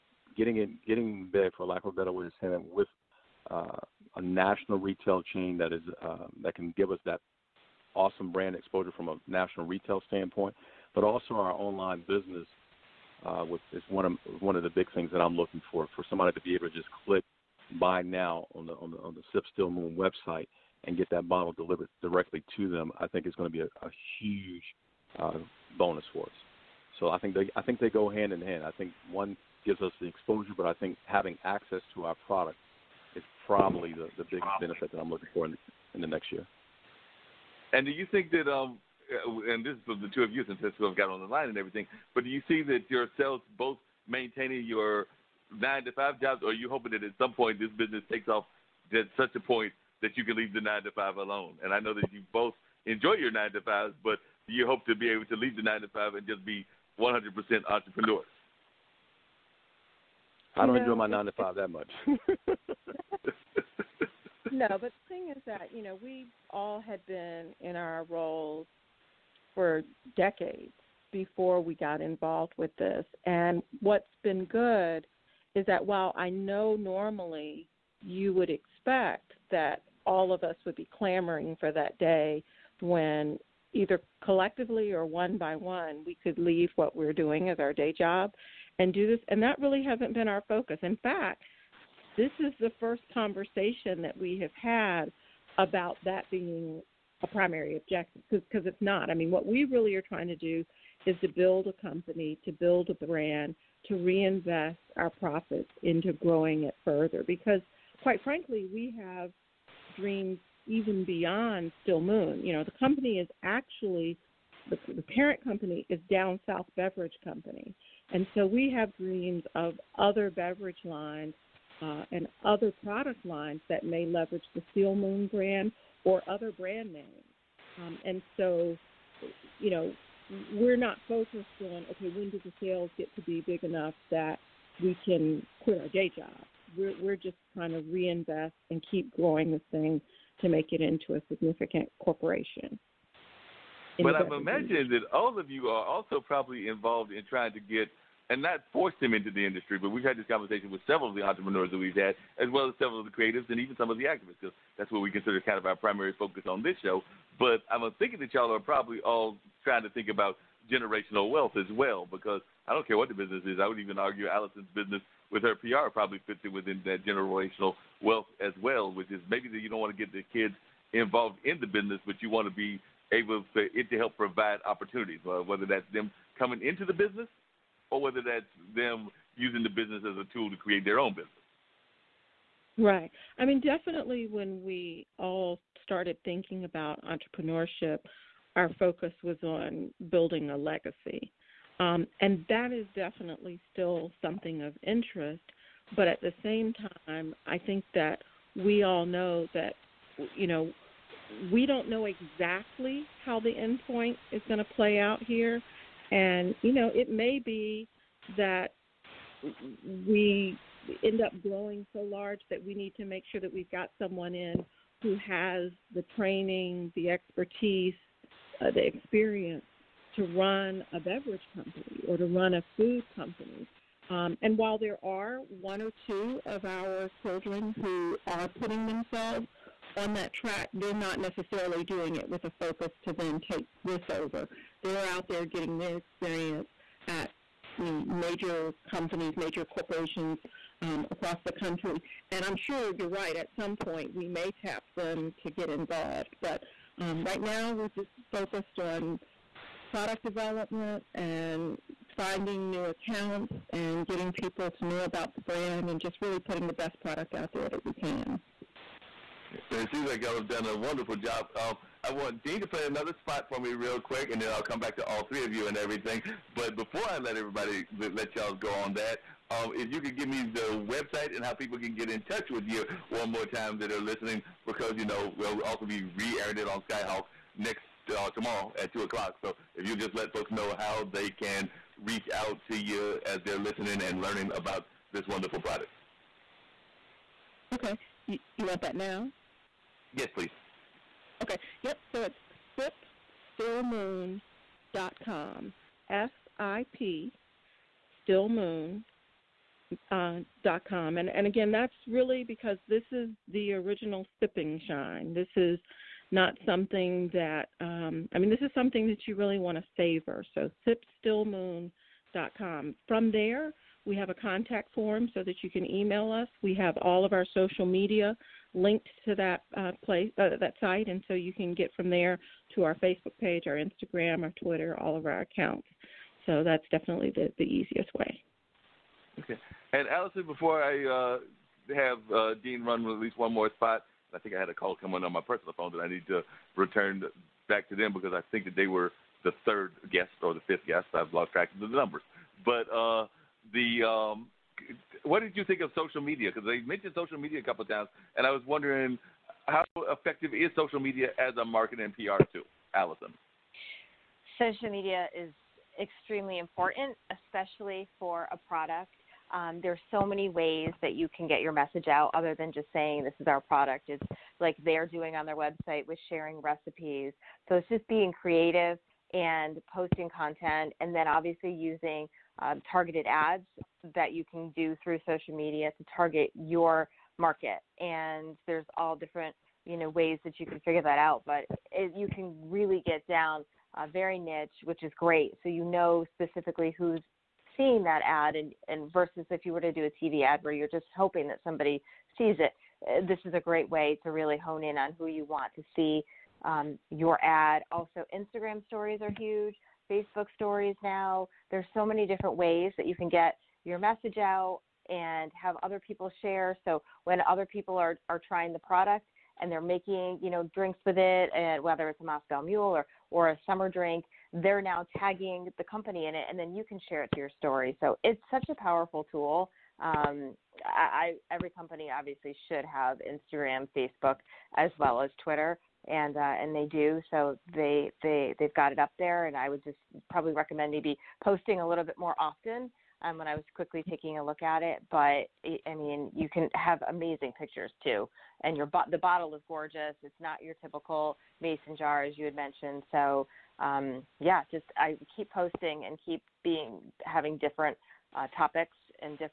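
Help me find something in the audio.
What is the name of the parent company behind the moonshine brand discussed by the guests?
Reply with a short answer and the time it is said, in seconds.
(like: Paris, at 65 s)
Down South Beverage Company, at 116 s.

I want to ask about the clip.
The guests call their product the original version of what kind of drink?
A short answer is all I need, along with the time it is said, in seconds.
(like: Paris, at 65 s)
sipping shine, at 304 s.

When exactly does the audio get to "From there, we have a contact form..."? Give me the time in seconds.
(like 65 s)
313 s.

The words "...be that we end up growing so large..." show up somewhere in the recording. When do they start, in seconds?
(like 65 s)
207 s.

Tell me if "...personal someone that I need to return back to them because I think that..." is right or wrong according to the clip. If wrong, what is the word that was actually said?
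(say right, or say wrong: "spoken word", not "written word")
wrong: "phone", not "someone".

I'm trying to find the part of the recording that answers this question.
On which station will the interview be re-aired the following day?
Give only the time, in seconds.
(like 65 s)
276 s.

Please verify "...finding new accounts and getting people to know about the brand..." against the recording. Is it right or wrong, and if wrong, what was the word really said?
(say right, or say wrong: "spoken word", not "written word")
right.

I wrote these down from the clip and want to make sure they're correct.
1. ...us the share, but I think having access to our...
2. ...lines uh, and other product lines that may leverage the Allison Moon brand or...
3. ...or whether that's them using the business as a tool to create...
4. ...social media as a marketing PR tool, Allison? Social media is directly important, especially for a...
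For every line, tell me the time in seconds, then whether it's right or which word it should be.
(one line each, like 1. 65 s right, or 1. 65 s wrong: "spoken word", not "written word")
1. 29 s wrong: "exposure", not "share"
2. 120 s wrong: "Still", not "Allison"
3. 177 s right
4. 350 s wrong: "extremely", not "directly".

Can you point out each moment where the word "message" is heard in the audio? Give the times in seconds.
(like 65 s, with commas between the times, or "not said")
361 s, 403 s.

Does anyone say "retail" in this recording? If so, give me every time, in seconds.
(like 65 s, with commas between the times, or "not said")
4 s, 9 s.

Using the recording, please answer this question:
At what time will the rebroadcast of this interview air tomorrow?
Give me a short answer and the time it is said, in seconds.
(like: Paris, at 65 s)
2 o'clock, at 278 s.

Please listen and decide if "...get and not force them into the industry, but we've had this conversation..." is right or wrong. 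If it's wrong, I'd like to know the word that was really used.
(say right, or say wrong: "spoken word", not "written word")
right.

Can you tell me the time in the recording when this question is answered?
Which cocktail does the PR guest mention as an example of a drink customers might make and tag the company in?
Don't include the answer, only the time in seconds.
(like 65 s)
412 s.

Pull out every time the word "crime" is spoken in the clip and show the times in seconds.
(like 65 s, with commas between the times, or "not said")
not said.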